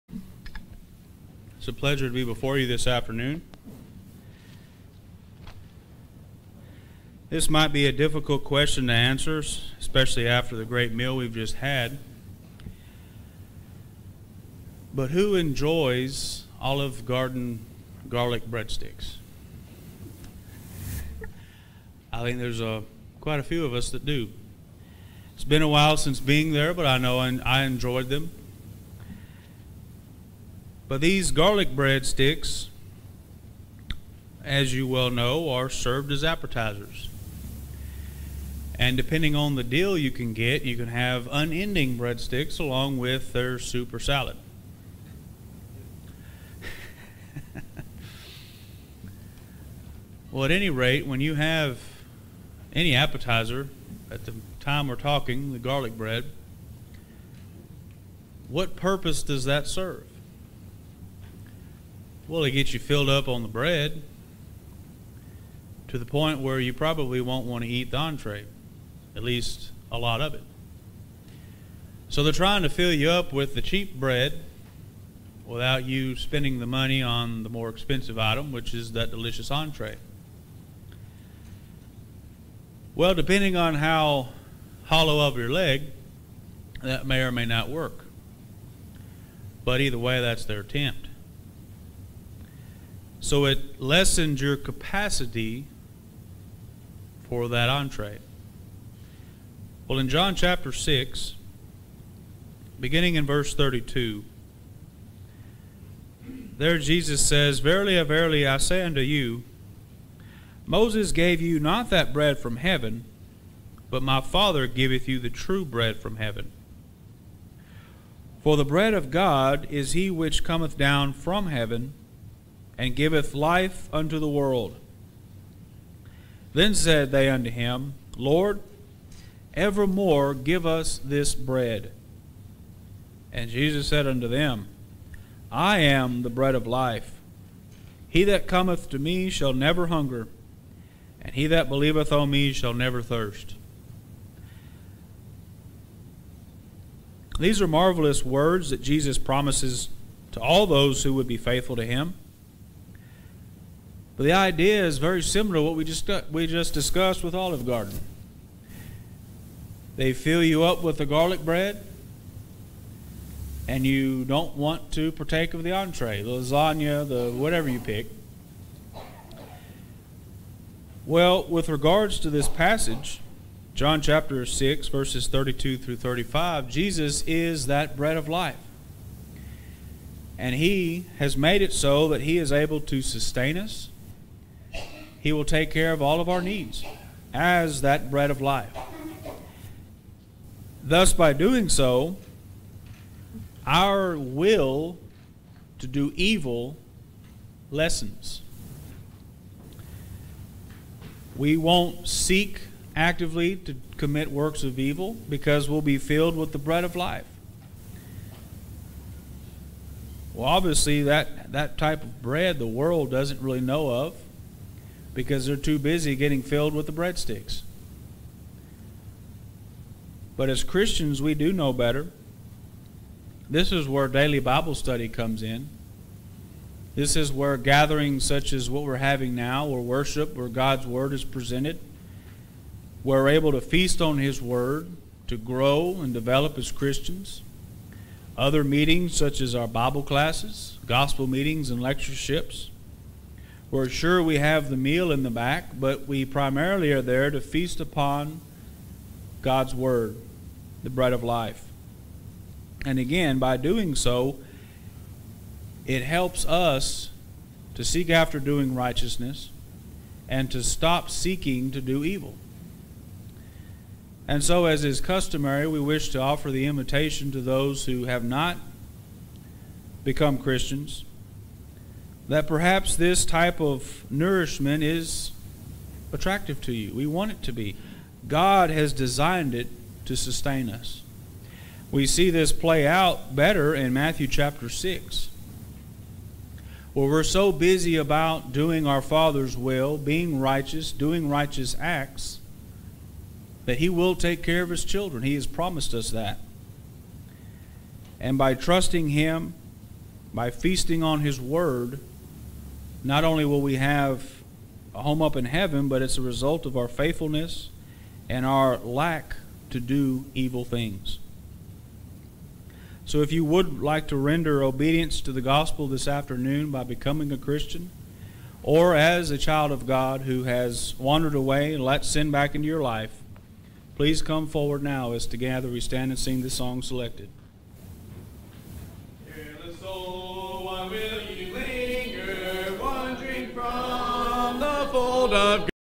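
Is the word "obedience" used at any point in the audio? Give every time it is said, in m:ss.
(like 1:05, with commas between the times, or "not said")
5:14.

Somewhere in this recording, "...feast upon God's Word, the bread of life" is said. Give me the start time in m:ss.
4:07.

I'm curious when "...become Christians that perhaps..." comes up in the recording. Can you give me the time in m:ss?
4:30.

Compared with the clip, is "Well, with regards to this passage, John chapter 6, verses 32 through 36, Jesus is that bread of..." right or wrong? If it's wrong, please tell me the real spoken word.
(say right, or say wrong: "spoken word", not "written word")
wrong: "35", not "36".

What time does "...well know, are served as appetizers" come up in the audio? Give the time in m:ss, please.
0:34.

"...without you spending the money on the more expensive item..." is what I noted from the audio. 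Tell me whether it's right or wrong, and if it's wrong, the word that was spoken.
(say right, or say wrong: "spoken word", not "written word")
right.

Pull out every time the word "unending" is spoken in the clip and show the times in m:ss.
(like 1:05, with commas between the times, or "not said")
0:41.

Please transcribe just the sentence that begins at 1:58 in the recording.
For the bread of God is he which cometh down from heaven and giveth life unto the world.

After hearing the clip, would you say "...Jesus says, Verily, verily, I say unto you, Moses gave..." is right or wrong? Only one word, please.
right.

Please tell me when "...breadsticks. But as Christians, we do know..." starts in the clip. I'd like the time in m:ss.
3:36.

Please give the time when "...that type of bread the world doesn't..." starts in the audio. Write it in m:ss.
3:31.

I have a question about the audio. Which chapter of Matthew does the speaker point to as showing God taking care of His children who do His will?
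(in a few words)
Matthew chapter 6.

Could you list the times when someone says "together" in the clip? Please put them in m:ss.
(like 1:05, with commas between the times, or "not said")
5:25.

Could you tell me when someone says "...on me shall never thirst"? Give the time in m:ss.
2:22.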